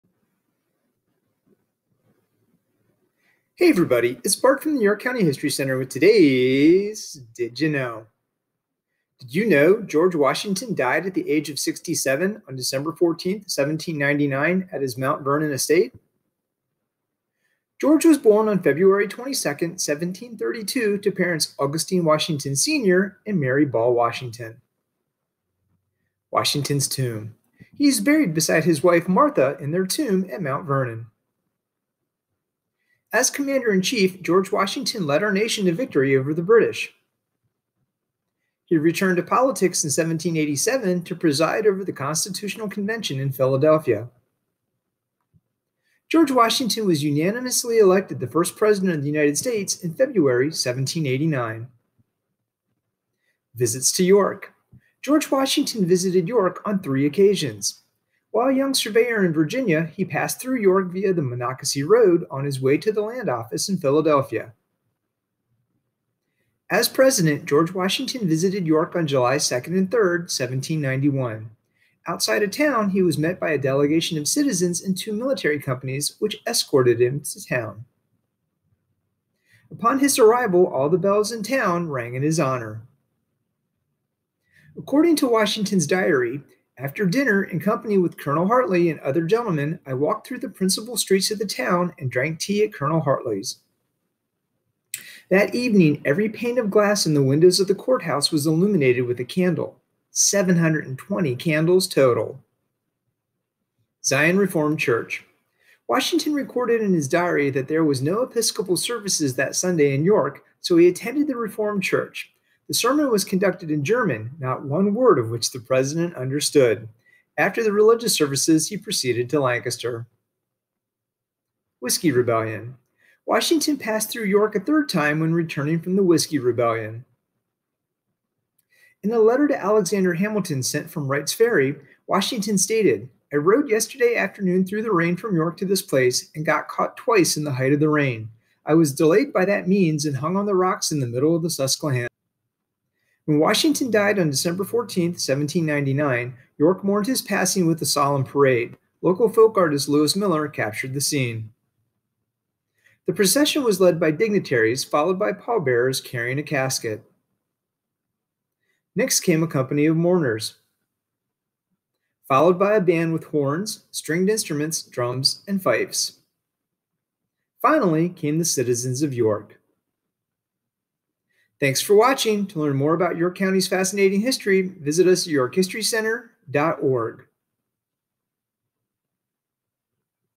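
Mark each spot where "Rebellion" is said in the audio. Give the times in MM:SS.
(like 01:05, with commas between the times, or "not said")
02:02, 02:06.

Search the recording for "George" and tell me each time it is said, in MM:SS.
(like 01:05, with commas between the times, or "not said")
00:09, 00:17, 00:34, 00:46, 00:55, 01:07.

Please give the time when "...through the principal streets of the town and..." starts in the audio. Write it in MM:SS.
01:30.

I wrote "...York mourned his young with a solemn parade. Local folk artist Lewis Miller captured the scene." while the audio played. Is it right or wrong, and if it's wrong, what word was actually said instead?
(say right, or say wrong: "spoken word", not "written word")
wrong: "passing", not "young".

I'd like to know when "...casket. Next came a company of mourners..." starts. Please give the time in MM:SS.
02:36.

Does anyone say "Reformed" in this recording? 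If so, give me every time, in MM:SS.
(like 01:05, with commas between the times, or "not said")
01:44, 01:51.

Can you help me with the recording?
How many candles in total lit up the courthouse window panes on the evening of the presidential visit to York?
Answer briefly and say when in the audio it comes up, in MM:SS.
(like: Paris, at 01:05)
720, at 01:40.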